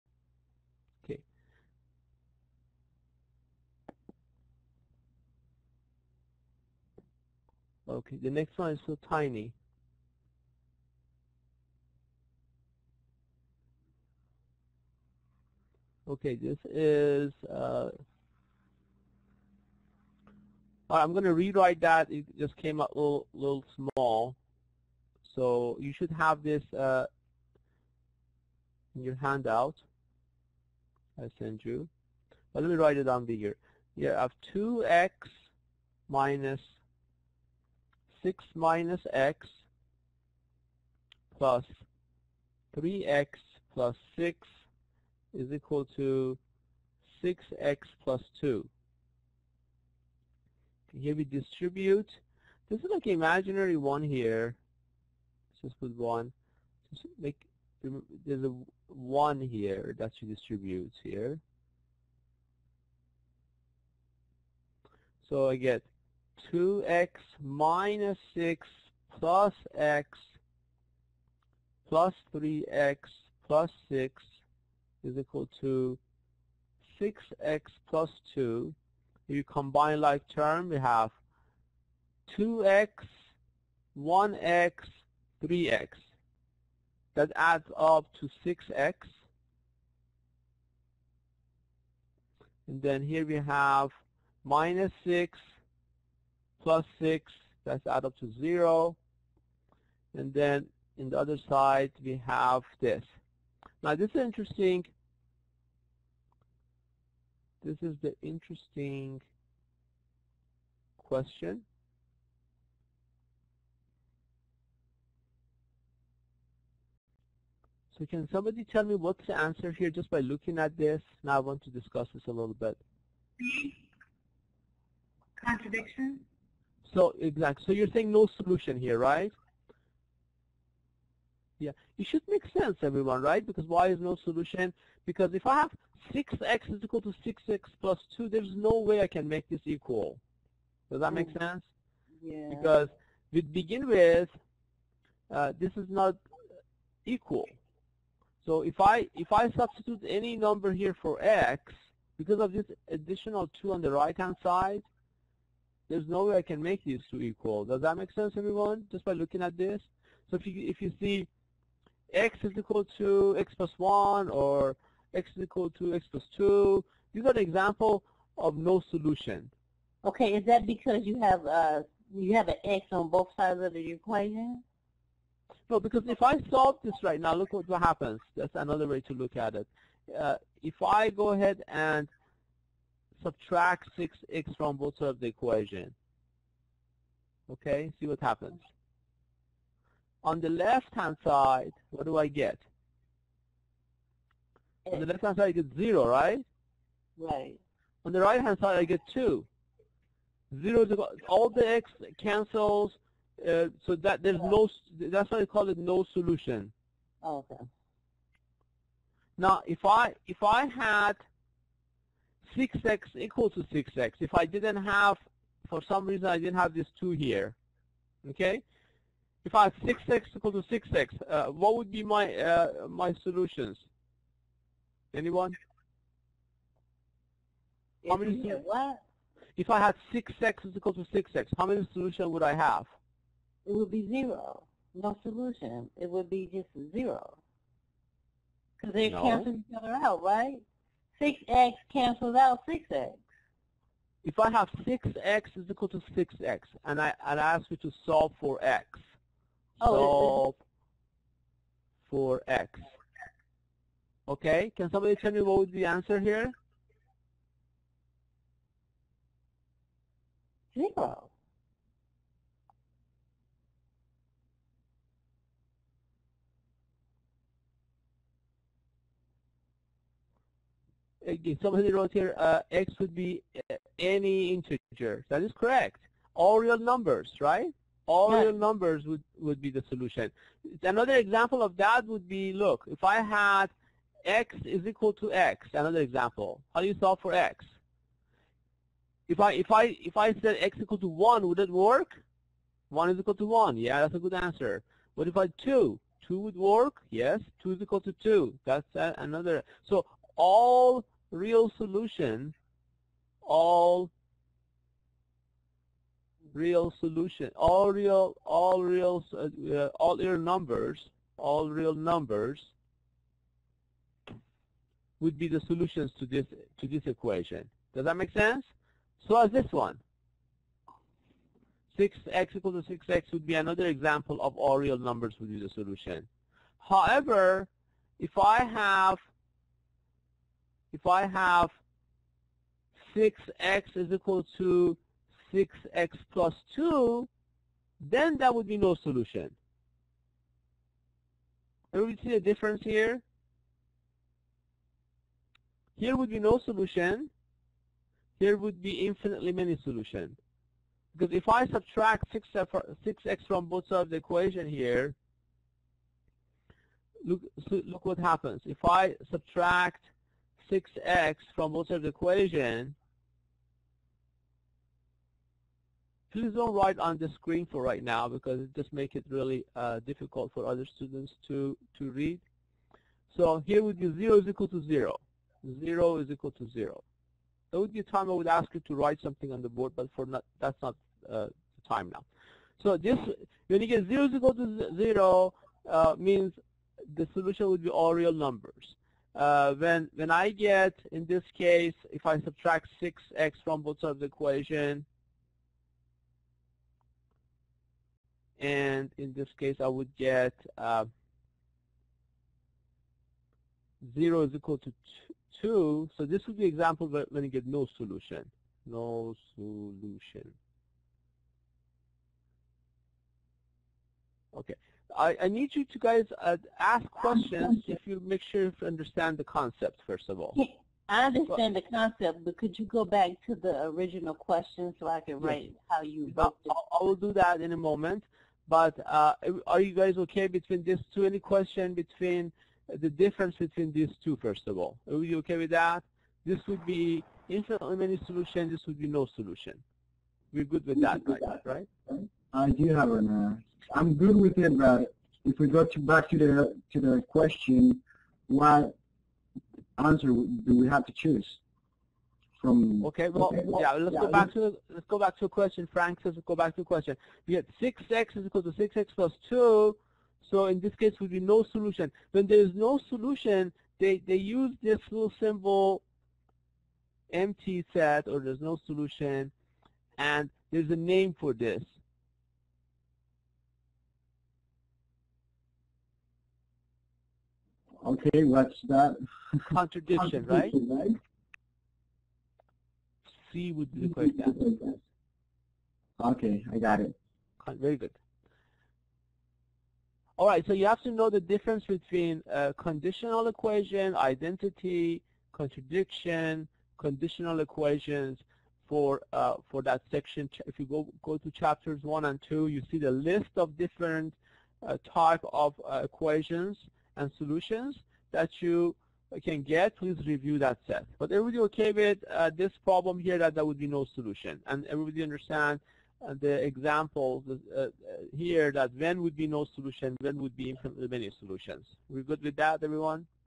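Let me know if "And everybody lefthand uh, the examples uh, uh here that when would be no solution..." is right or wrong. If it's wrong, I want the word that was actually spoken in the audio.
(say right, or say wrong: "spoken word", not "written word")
wrong: "understand", not "lefthand".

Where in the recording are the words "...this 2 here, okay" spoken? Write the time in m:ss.
3:36.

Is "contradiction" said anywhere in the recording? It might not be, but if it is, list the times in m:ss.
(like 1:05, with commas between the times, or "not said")
2:05, 7:59, 8:15.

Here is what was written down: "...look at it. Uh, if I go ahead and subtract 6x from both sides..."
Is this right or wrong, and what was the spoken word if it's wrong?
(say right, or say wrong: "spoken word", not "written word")
right.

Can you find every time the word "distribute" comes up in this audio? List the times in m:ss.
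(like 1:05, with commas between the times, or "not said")
0:51, 1:00.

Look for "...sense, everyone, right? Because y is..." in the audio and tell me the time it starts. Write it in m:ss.
2:12.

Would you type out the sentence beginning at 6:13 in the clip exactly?
So here would be 0 is equal to 0.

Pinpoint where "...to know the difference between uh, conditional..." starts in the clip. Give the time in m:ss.
8:11.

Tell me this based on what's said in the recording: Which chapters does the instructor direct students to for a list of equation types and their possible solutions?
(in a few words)
one and two.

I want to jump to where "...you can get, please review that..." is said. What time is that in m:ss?
8:28.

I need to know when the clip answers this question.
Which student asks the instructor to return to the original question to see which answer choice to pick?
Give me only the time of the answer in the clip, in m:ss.
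7:35.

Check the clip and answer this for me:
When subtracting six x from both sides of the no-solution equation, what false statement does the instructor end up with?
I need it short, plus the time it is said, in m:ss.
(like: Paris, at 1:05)
0 = 2, at 6:44.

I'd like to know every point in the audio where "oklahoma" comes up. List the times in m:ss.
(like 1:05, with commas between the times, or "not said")
not said.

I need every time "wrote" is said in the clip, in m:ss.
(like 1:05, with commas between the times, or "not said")
4:31, 7:06.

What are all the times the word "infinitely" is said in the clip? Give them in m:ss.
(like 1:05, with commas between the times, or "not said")
5:49, 7:17.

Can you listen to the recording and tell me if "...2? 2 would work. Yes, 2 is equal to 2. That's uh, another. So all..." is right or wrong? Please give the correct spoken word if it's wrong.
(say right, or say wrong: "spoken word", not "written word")
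right.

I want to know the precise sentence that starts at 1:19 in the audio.
If you combine like term, we have 2x, 1x, 3x.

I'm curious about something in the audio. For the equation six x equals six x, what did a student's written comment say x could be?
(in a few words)
integer.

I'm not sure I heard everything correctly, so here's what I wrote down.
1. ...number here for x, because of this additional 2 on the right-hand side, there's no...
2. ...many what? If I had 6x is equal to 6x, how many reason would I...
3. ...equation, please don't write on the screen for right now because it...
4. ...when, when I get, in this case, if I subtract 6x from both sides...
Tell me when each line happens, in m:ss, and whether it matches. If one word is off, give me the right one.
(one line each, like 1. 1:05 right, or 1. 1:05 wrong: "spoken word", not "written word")
1. 2:30 right
2. 3:48 wrong: "solution", not "reason"
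3. 6:02 right
4. 6:29 right.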